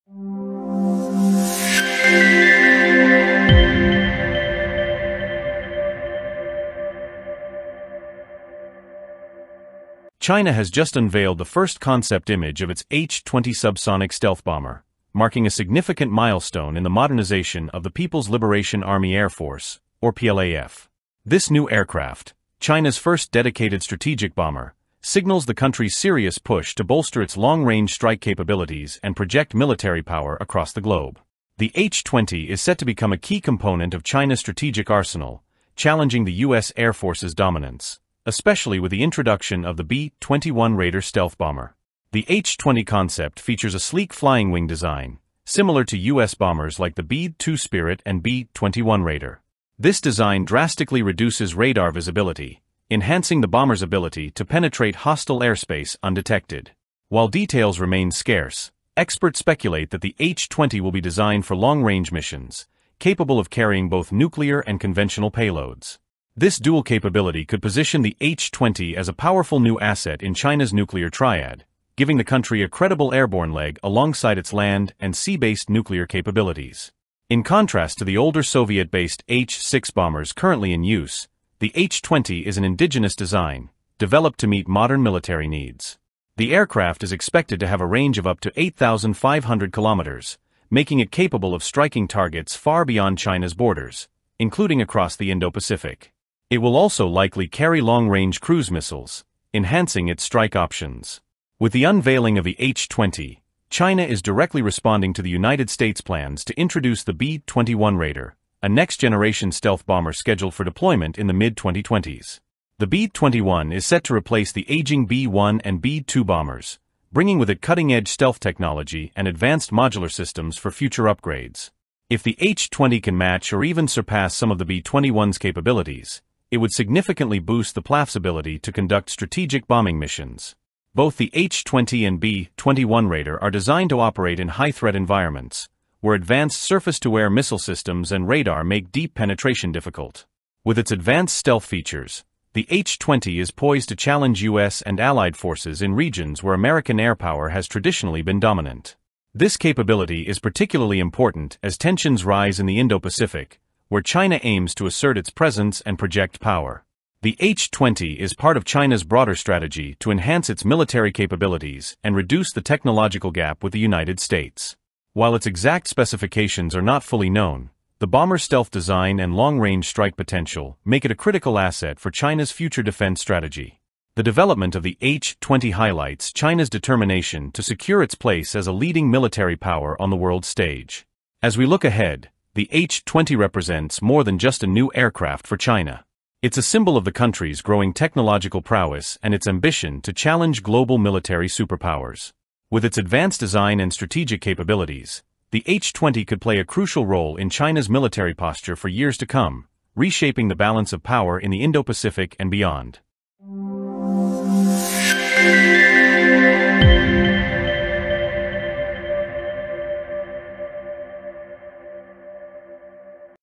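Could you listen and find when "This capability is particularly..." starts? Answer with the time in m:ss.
2:29.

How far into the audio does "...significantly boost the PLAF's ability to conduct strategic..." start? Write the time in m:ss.
2:06.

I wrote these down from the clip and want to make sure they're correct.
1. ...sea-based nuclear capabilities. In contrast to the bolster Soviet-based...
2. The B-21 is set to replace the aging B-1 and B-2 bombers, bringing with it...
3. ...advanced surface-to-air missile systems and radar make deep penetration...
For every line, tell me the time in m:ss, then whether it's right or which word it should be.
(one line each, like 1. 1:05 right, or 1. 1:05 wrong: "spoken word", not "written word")
1. 1:15 wrong: "older", not "bolster"
2. 1:52 right
3. 2:16 right.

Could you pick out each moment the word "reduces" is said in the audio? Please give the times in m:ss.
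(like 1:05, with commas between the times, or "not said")
0:51, 2:42.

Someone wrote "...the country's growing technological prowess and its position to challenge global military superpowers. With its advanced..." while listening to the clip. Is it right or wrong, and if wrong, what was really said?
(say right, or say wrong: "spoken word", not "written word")
wrong: "ambition", not "position".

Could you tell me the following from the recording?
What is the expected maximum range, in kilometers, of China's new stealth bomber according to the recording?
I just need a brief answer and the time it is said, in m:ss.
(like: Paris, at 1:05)
8,500 kilometers, at 1:28.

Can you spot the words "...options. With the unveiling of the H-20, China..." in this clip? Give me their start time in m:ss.
1:40.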